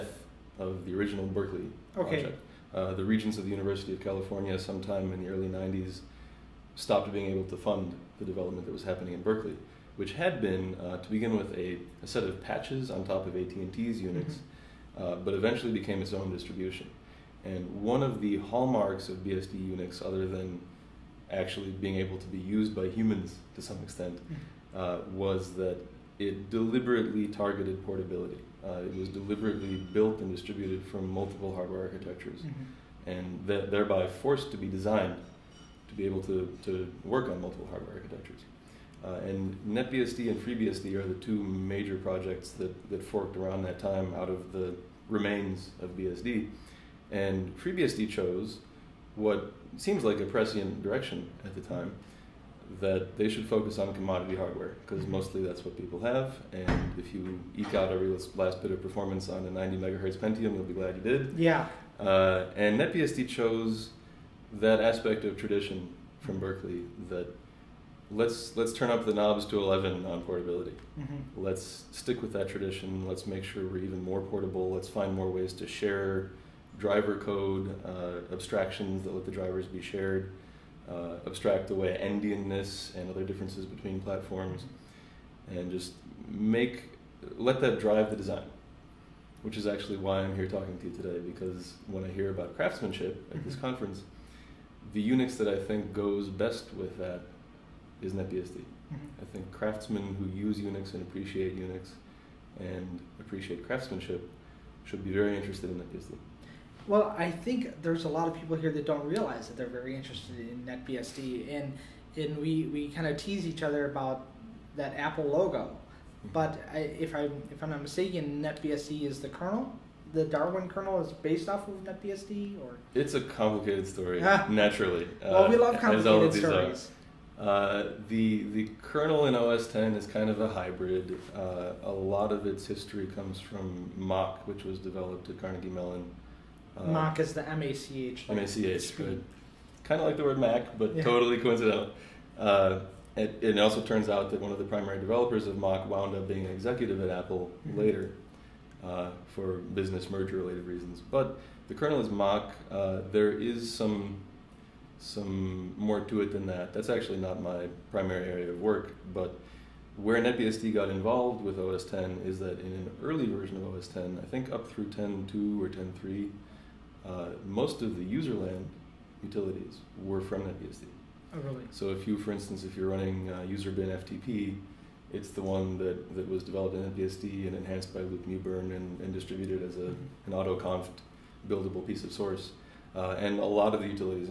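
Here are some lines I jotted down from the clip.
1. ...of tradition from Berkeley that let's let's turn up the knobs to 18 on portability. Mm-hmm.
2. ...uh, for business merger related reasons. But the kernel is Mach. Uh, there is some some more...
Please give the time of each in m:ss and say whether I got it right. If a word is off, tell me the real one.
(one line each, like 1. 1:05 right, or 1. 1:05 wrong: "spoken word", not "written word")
1. 1:05 wrong: "11", not "18"
2. 2:28 right.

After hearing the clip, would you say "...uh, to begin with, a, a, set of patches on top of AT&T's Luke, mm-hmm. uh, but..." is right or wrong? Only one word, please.
wrong.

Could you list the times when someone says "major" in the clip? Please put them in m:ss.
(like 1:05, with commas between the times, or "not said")
0:41.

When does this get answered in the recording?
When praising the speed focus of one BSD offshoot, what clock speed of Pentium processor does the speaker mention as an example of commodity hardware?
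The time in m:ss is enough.
0:59.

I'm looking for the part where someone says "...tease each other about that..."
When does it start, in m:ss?
1:53.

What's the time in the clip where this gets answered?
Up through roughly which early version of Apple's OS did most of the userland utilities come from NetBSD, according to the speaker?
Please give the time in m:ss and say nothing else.
2:44.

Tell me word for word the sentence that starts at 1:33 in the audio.
conference, the Unix that I think goes best with that is NetBSD.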